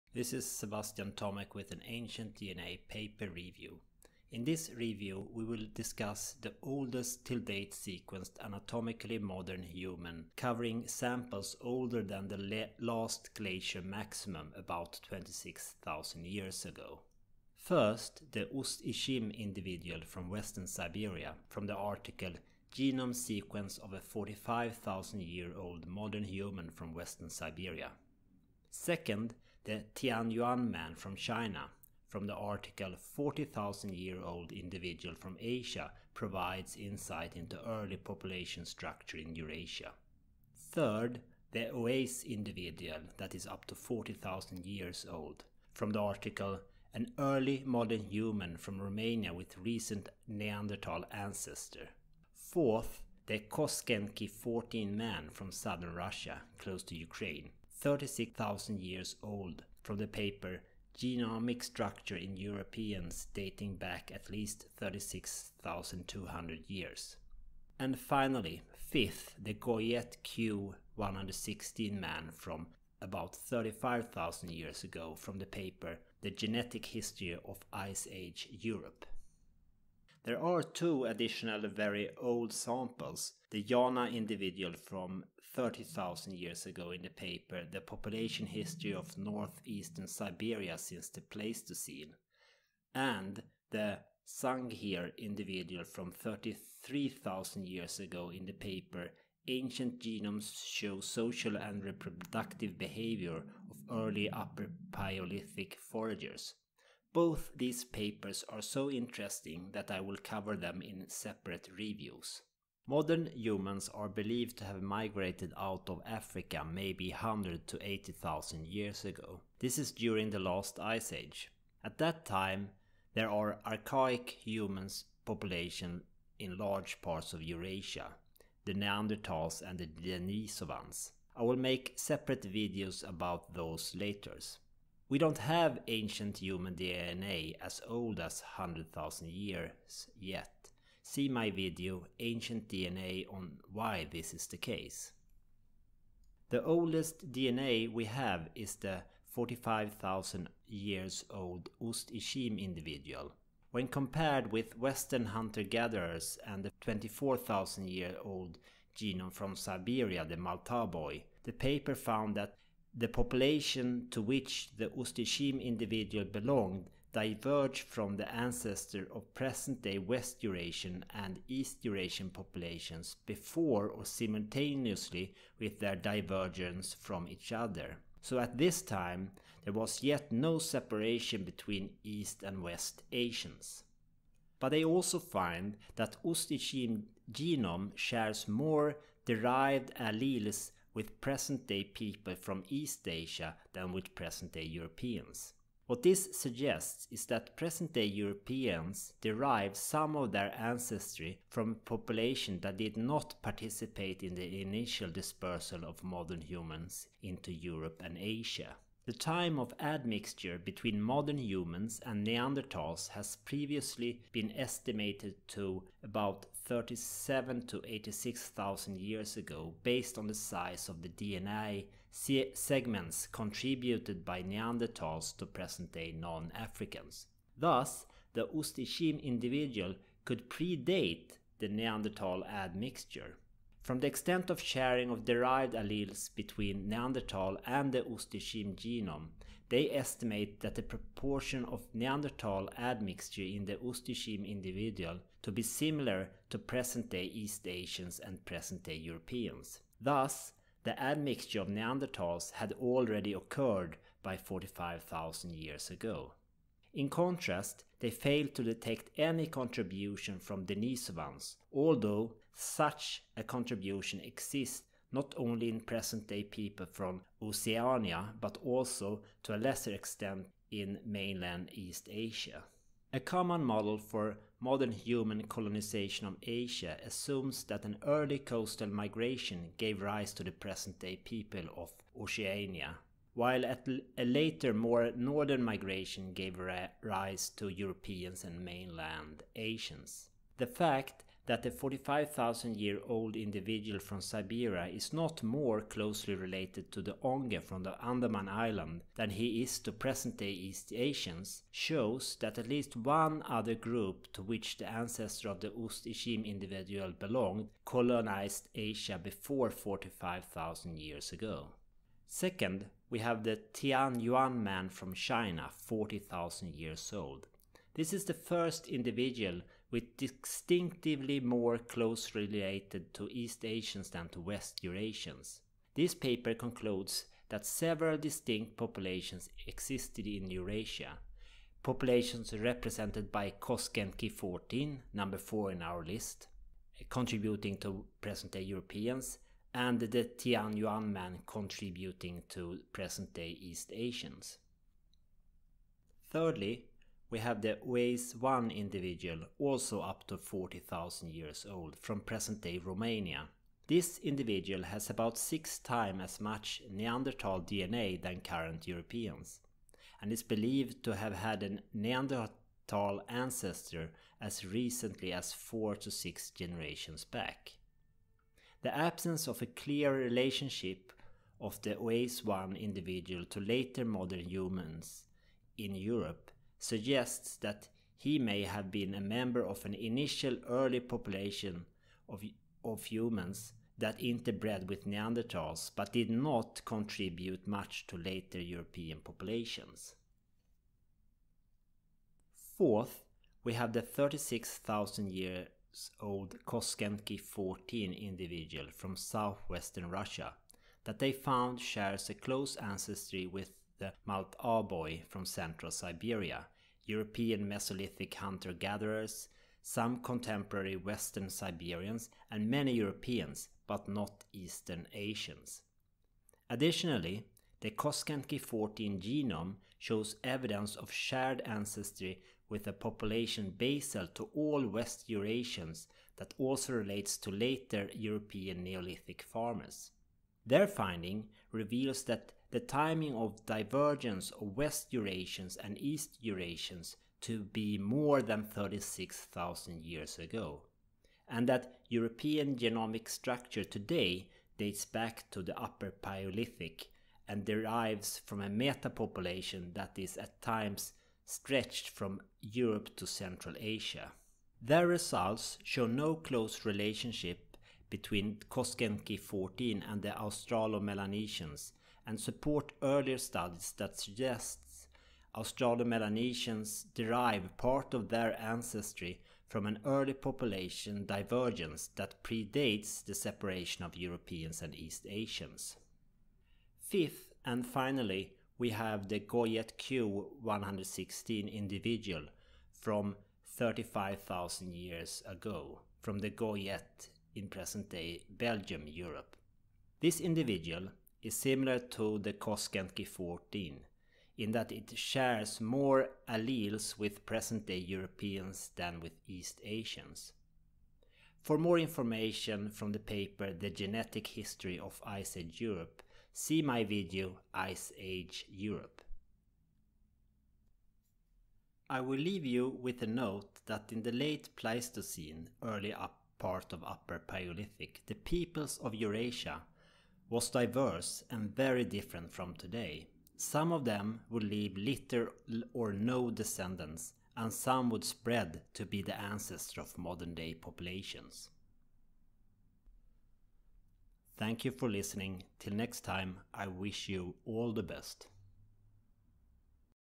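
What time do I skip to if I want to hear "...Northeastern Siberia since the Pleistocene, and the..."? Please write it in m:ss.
1:29.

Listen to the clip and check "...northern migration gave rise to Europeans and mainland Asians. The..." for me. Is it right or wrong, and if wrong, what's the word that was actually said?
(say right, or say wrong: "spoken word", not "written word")
right.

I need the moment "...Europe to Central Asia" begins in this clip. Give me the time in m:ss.
7:32.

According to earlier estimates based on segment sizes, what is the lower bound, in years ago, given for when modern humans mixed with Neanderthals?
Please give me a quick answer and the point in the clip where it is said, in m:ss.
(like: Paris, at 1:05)
37,000, at 3:36.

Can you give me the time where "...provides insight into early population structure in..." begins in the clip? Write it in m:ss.
0:36.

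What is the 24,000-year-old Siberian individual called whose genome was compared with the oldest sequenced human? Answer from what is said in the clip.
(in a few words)
Malta boy.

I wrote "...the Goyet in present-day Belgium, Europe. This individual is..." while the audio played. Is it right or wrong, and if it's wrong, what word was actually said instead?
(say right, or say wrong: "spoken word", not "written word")
right.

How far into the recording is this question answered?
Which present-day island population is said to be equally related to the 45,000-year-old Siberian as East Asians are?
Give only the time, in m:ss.
4:57.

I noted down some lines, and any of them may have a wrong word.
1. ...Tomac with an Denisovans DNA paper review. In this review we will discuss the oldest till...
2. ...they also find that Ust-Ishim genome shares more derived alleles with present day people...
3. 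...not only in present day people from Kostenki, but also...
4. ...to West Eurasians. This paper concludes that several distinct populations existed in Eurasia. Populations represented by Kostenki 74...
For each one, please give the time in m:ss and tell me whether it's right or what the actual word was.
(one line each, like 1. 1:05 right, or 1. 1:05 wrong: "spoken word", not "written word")
1. 0:01 wrong: "Ancient", not "Denisovans"
2. 3:04 right
3. 4:25 wrong: "Oceania", not "Kostenki"
4. 5:24 wrong: "14", not "74".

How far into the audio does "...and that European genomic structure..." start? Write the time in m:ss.
7:21.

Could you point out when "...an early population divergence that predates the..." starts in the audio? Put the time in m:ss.
7:49.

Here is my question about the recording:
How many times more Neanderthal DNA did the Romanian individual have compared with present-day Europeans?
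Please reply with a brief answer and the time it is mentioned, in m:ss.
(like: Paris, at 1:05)
6, at 5:55.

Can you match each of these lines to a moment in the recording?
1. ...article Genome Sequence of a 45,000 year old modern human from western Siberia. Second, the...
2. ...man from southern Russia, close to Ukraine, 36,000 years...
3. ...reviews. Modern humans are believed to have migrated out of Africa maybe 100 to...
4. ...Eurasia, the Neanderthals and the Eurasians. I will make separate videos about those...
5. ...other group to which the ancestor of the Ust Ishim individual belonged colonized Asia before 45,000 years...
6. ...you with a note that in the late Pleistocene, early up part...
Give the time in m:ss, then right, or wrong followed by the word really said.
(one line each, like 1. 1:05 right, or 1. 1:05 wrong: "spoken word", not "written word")
1. 0:21 right
2. 0:54 right
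3. 1:51 right
4. 2:07 wrong: "Denisovans", not "Eurasians"
5. 5:03 right
6. 8:32 right.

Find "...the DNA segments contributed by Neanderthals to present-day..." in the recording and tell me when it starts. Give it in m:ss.
3:41.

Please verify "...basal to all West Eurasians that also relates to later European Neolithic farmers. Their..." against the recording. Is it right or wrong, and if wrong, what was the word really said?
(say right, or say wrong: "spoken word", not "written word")
right.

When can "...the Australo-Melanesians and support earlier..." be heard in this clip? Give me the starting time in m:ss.
7:40.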